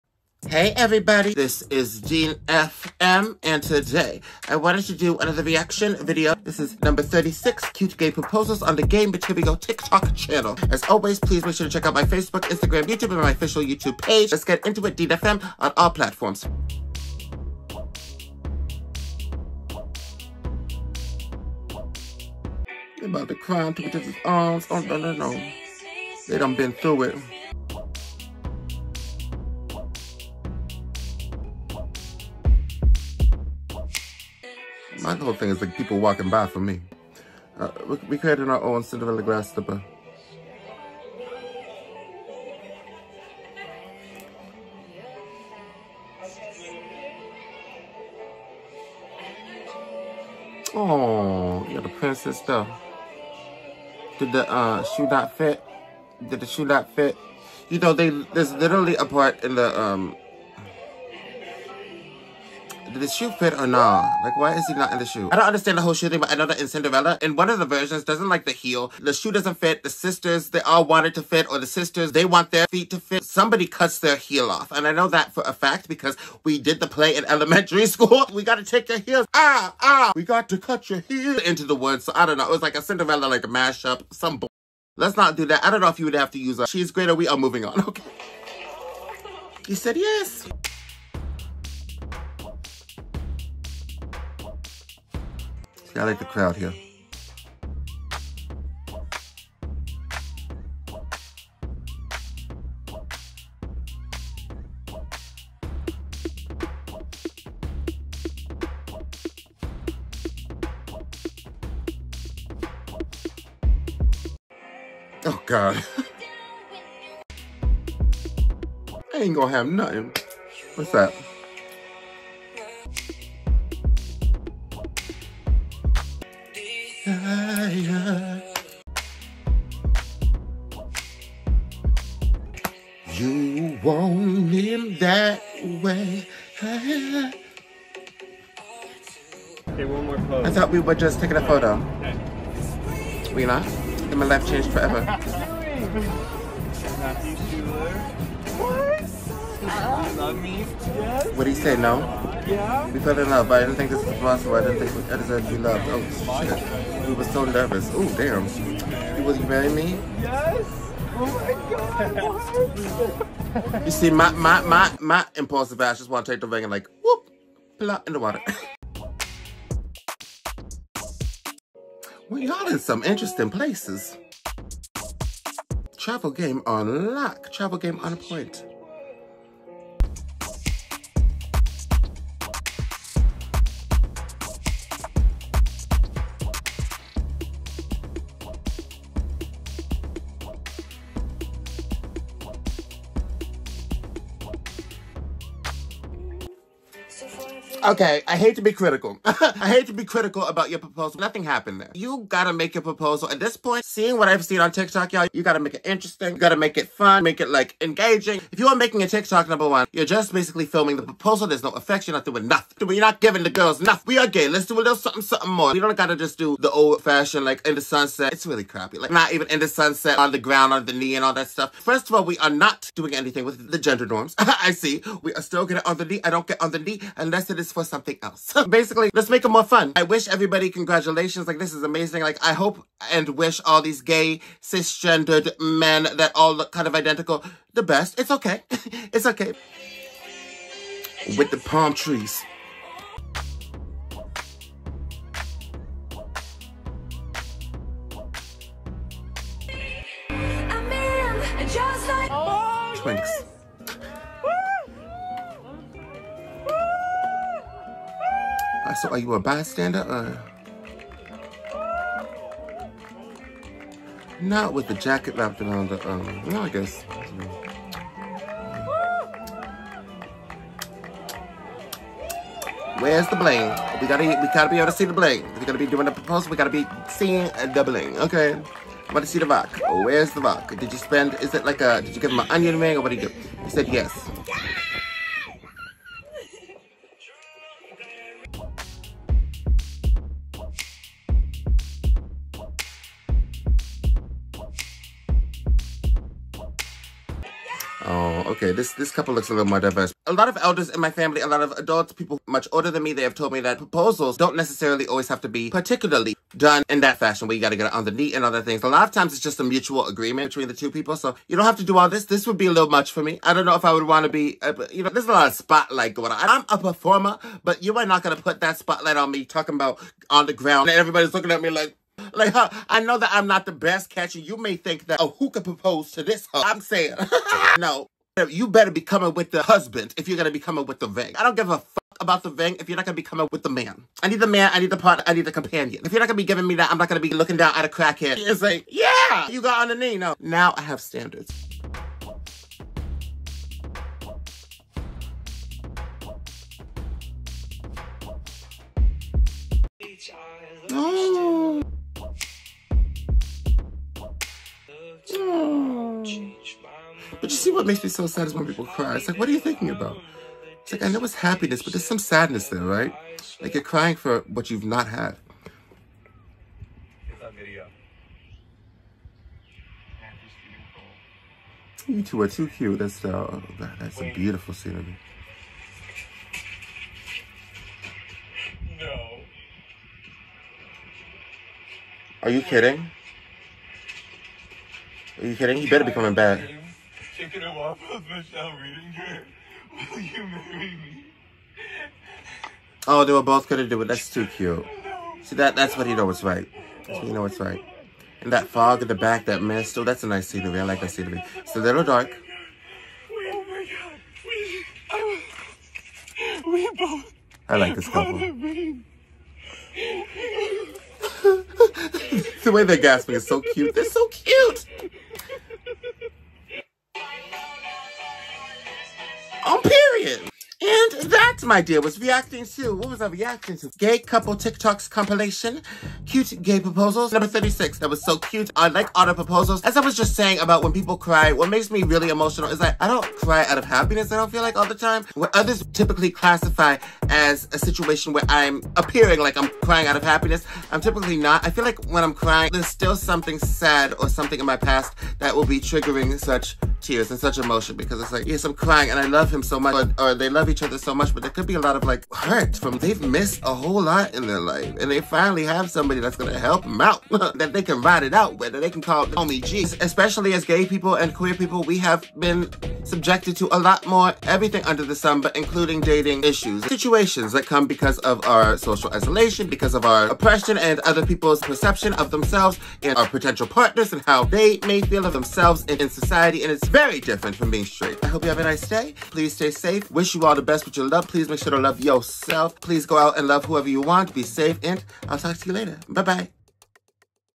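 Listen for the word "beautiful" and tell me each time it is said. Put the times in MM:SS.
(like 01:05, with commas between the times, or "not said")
06:14.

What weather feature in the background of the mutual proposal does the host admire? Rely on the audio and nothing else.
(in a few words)
fog.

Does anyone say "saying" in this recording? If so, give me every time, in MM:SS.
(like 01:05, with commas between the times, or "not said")
05:26, 07:10.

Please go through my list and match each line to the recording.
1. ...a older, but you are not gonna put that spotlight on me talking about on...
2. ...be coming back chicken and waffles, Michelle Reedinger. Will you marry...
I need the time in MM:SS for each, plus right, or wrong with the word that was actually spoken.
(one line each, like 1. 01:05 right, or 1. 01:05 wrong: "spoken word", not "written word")
1. 05:16 wrong: "performer", not "older"
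2. 06:26 right.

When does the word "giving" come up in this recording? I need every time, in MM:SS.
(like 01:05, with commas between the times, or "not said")
03:33, 05:36.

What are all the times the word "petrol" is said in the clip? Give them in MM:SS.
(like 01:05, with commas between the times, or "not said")
not said.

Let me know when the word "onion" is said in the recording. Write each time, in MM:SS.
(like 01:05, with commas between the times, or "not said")
04:42.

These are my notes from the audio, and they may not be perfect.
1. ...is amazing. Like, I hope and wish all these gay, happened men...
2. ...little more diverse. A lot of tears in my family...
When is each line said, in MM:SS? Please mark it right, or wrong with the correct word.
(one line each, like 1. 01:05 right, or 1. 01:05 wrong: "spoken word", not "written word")
1. 03:51 wrong: "cisgendered", not "happened"
2. 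04:59 wrong: "elders", not "tears".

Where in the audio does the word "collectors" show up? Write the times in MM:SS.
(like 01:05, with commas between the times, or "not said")
not said.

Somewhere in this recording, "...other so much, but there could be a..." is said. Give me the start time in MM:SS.
07:30.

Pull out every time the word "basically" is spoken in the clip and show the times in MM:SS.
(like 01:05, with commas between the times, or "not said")
03:30, 03:48.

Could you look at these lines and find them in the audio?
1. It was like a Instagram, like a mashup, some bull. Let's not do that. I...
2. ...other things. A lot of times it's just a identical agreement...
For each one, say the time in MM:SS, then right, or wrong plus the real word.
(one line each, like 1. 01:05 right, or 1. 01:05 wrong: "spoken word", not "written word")
1. 01:22 wrong: "Cinderella", not "Instagram"
2. 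05:08 wrong: "mutual", not "identical".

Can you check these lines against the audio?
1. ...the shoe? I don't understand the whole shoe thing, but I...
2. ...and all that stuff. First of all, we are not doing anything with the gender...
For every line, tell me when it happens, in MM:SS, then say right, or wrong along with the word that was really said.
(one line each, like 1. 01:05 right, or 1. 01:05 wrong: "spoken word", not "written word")
1. 01:04 right
2. 03:41 right.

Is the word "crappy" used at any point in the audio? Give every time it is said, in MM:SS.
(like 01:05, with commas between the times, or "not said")
03:38.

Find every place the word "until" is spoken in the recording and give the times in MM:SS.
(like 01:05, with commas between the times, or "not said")
not said.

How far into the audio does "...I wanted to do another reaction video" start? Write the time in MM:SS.
00:04.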